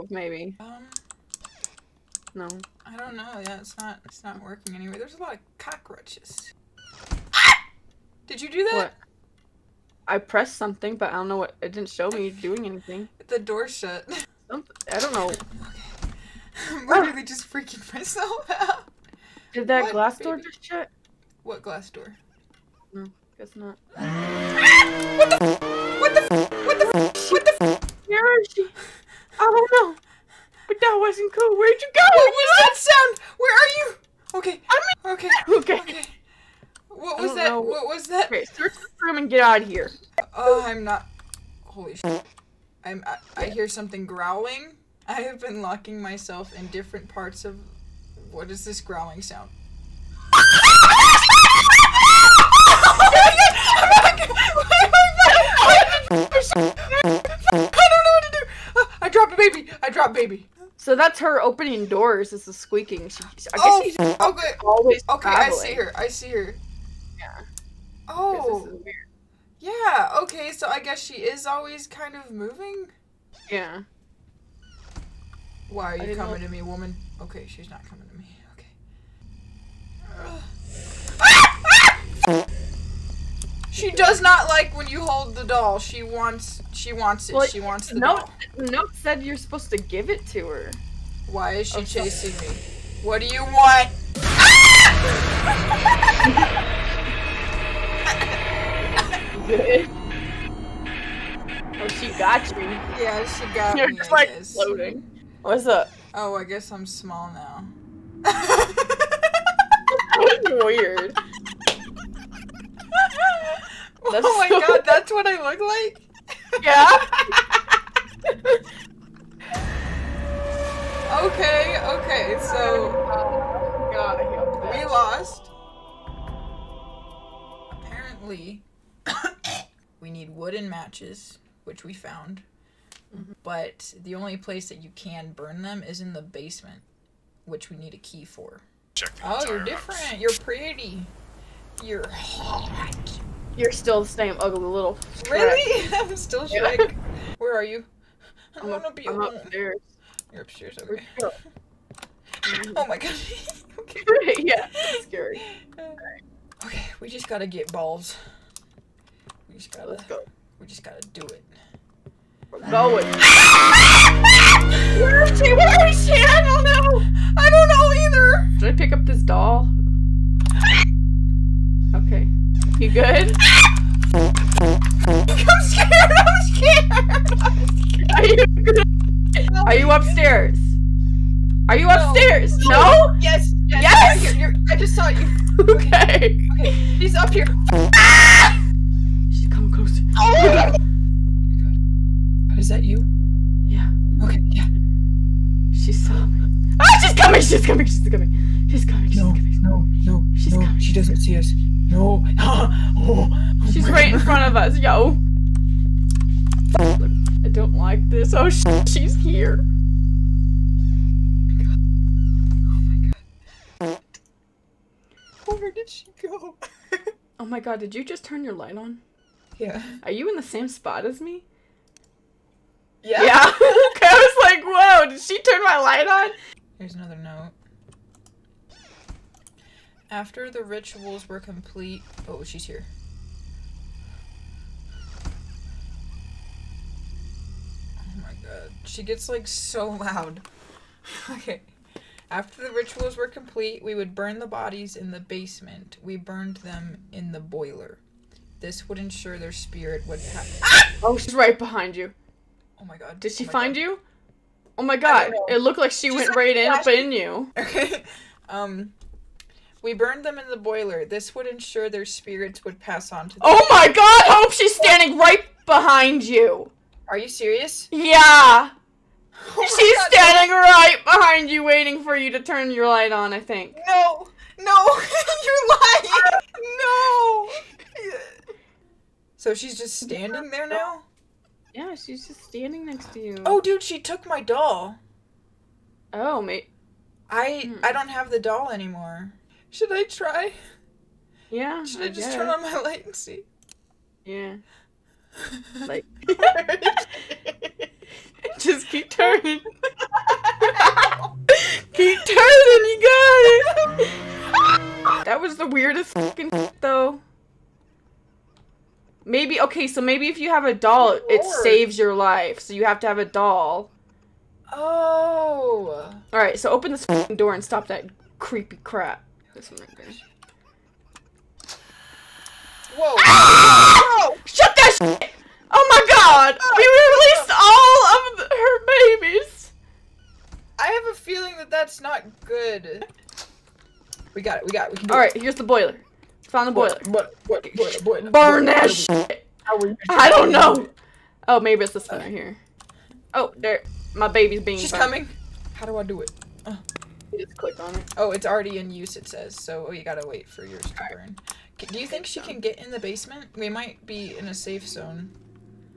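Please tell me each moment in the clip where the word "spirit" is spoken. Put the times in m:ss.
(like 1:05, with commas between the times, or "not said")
4:09, 4:22.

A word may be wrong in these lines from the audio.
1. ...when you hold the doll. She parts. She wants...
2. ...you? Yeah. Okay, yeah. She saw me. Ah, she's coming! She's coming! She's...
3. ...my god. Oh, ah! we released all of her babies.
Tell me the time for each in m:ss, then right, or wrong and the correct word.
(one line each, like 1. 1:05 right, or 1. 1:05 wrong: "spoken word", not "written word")
1. 1:24 wrong: "wants", not "parts"
2. 3:12 right
3. 5:25 right.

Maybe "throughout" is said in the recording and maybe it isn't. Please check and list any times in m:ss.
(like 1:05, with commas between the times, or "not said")
not said.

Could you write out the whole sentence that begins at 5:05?
that was the weirdest fucking though.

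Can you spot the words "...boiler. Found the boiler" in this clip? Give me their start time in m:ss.
5:35.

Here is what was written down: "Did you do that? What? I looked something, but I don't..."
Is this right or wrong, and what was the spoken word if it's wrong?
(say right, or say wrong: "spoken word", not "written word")
wrong: "pressed", not "looked".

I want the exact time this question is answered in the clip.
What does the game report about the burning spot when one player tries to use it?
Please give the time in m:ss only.
5:48.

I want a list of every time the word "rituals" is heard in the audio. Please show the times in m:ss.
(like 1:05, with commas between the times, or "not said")
3:50, 4:02.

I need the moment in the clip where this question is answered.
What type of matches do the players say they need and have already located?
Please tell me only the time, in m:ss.
2:10.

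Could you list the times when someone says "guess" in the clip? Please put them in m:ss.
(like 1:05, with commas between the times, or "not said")
0:23, 1:03, 1:10, 1:46, 4:52.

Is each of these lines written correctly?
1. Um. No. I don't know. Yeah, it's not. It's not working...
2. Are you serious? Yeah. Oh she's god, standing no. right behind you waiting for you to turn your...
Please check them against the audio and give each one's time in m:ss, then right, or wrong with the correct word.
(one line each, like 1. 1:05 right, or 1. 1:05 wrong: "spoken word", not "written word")
1. 0:00 right
2. 4:27 right.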